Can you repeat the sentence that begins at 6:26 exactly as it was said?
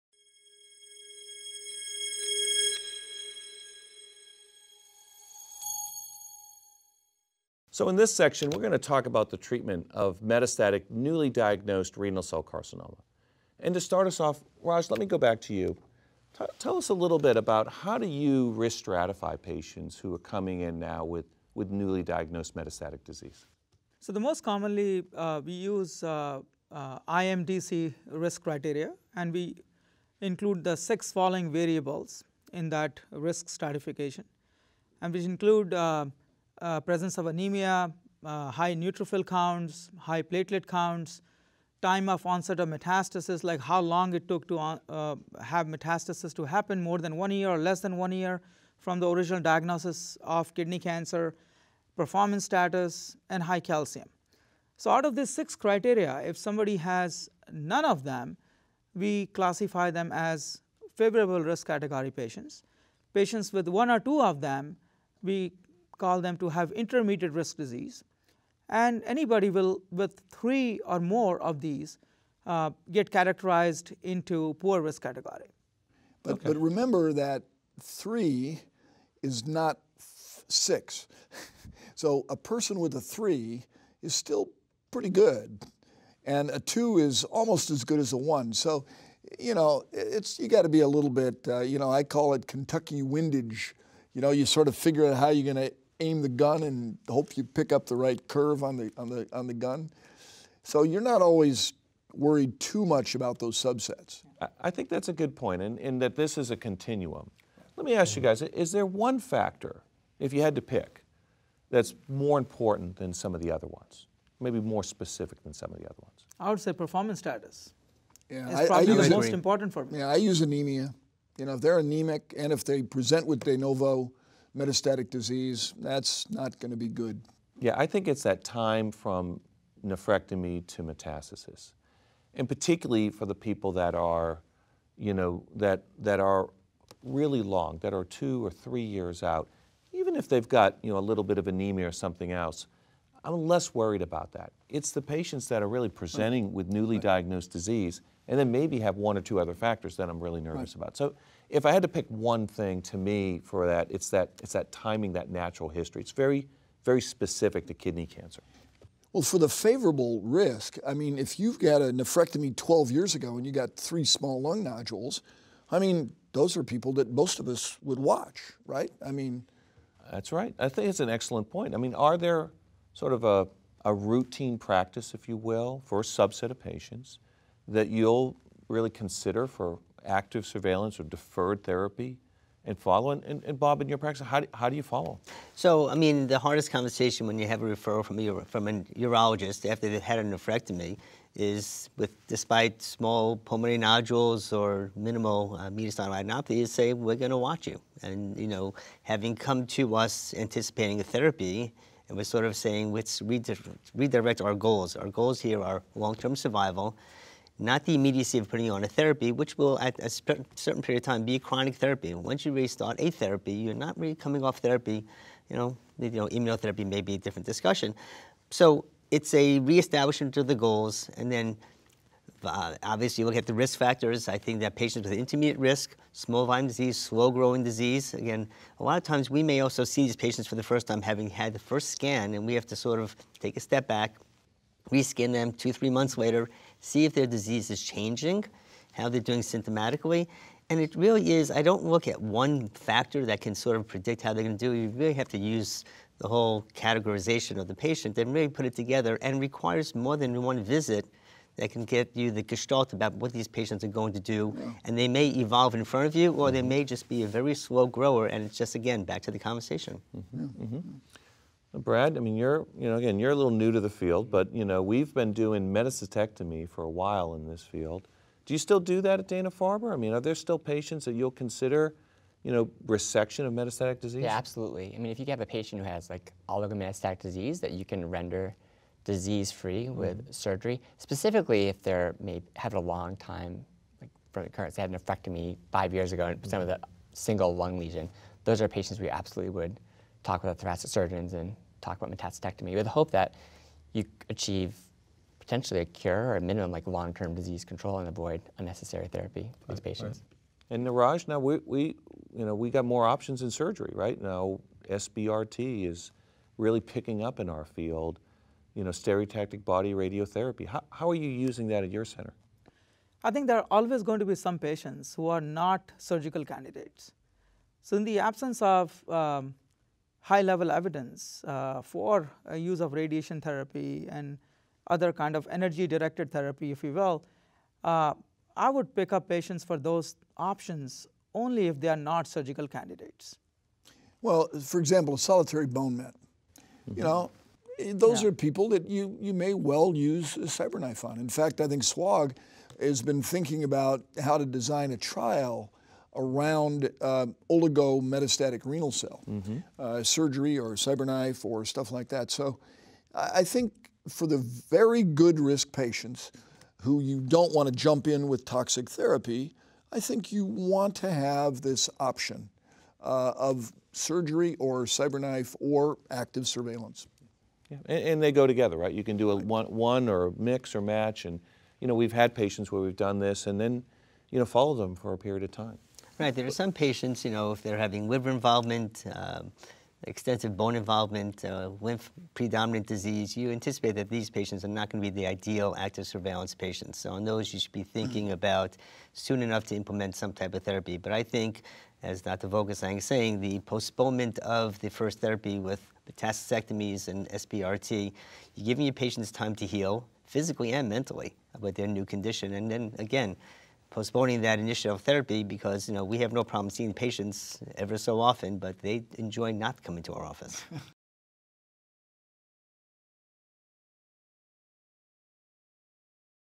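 So on those, you should be thinking mm-hmm.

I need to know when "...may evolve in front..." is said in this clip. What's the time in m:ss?
4:15.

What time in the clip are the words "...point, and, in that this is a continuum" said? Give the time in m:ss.
1:45.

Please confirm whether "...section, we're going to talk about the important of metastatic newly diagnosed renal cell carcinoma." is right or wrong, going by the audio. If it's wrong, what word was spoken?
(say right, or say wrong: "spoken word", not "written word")
wrong: "treatment", not "important".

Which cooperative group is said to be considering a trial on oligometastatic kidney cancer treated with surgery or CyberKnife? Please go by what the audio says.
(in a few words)
SWOG.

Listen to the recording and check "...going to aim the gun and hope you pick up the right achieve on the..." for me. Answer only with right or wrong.
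wrong.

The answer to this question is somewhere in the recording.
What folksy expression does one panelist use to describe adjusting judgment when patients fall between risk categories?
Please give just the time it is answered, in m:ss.
1:32.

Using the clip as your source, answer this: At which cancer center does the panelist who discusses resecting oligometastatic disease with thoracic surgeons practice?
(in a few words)
Dana-Farber.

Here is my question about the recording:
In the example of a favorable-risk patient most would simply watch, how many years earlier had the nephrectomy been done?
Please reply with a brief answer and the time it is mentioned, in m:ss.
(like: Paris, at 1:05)
12, at 2:42.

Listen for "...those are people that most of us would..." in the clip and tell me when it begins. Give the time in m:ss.
2:46.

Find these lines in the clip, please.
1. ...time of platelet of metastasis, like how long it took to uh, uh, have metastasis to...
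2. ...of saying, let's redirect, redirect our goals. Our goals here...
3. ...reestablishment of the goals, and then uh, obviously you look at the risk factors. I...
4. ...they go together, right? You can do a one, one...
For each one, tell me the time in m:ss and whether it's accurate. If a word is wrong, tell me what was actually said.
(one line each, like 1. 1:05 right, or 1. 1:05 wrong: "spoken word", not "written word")
1. 0:41 wrong: "onset", not "platelet"
2. 3:22 right
3. 3:39 right
4. 6:08 right.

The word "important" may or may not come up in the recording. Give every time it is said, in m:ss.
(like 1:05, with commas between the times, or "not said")
1:52, 1:59.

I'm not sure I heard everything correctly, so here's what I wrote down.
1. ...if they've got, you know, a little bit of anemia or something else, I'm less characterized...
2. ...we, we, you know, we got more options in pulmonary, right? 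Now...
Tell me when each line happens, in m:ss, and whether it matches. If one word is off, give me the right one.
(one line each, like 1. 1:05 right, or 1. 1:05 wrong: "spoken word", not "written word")
1. 2:20 wrong: "worried", not "characterized"
2. 5:01 wrong: "surgery", not "pulmonary".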